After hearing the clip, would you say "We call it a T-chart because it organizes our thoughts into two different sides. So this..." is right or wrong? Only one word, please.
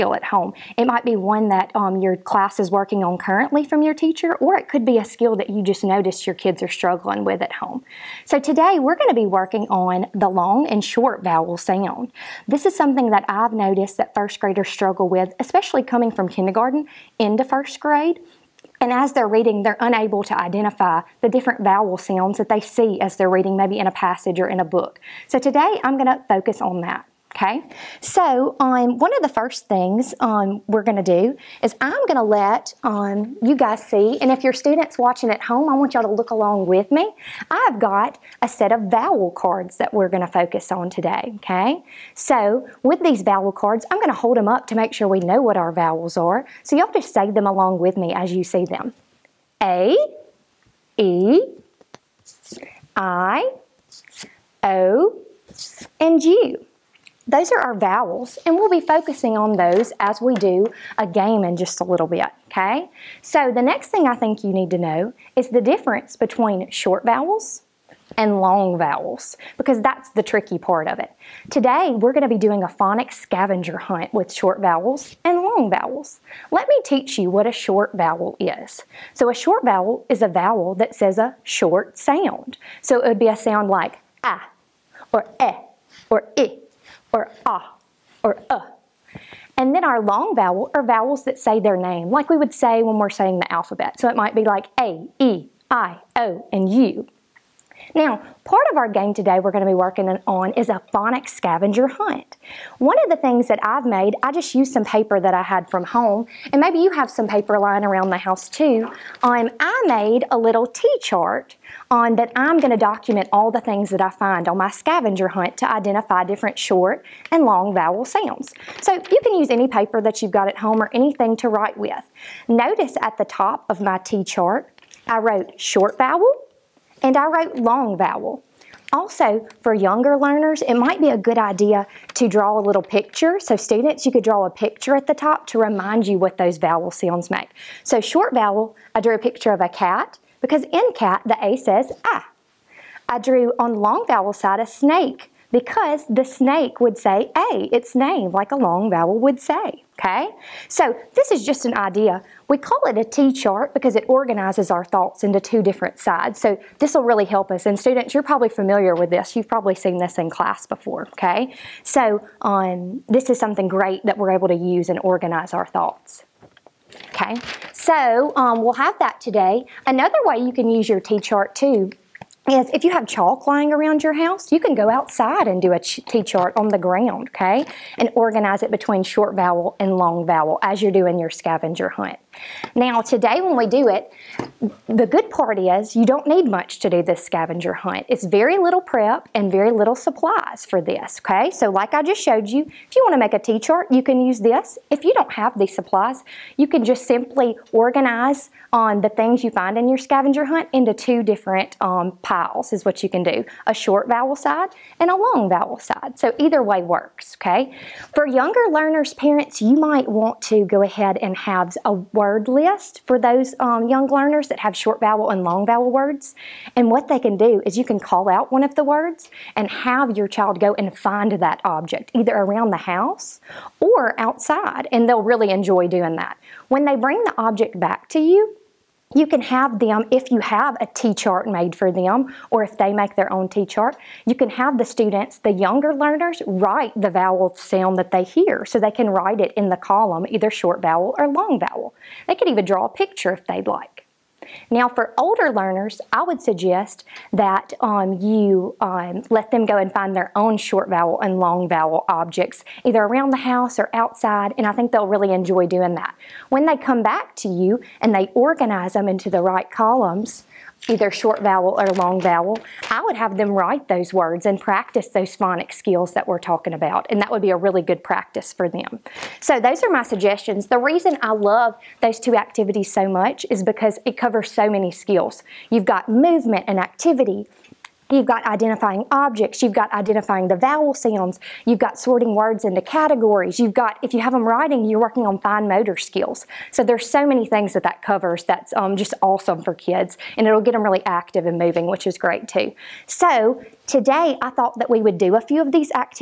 right.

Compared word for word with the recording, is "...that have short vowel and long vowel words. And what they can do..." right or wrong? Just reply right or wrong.
right.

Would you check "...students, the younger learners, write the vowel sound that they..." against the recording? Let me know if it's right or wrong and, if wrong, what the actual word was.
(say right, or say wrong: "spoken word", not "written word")
right.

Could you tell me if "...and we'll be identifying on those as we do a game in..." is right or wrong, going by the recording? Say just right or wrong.
wrong.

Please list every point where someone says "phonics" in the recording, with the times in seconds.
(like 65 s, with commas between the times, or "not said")
72 s, 100 s, 265 s.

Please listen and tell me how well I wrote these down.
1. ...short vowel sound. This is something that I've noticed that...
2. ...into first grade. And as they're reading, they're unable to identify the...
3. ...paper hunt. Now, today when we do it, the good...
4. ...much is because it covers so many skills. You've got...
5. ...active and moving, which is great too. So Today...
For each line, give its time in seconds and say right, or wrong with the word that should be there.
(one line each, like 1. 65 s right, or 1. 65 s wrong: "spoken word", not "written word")
1. 10 s right
2. 17 s right
3. 181 s wrong: "scavenger", not "paper"
4. 273 s right
5. 291 s right.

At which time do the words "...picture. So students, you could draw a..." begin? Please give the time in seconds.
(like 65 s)
132 s.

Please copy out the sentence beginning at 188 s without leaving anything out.
It's very little prep and very little supplies for this, okay?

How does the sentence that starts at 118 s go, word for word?
So you can use any paper that you've got at home or anything to write with.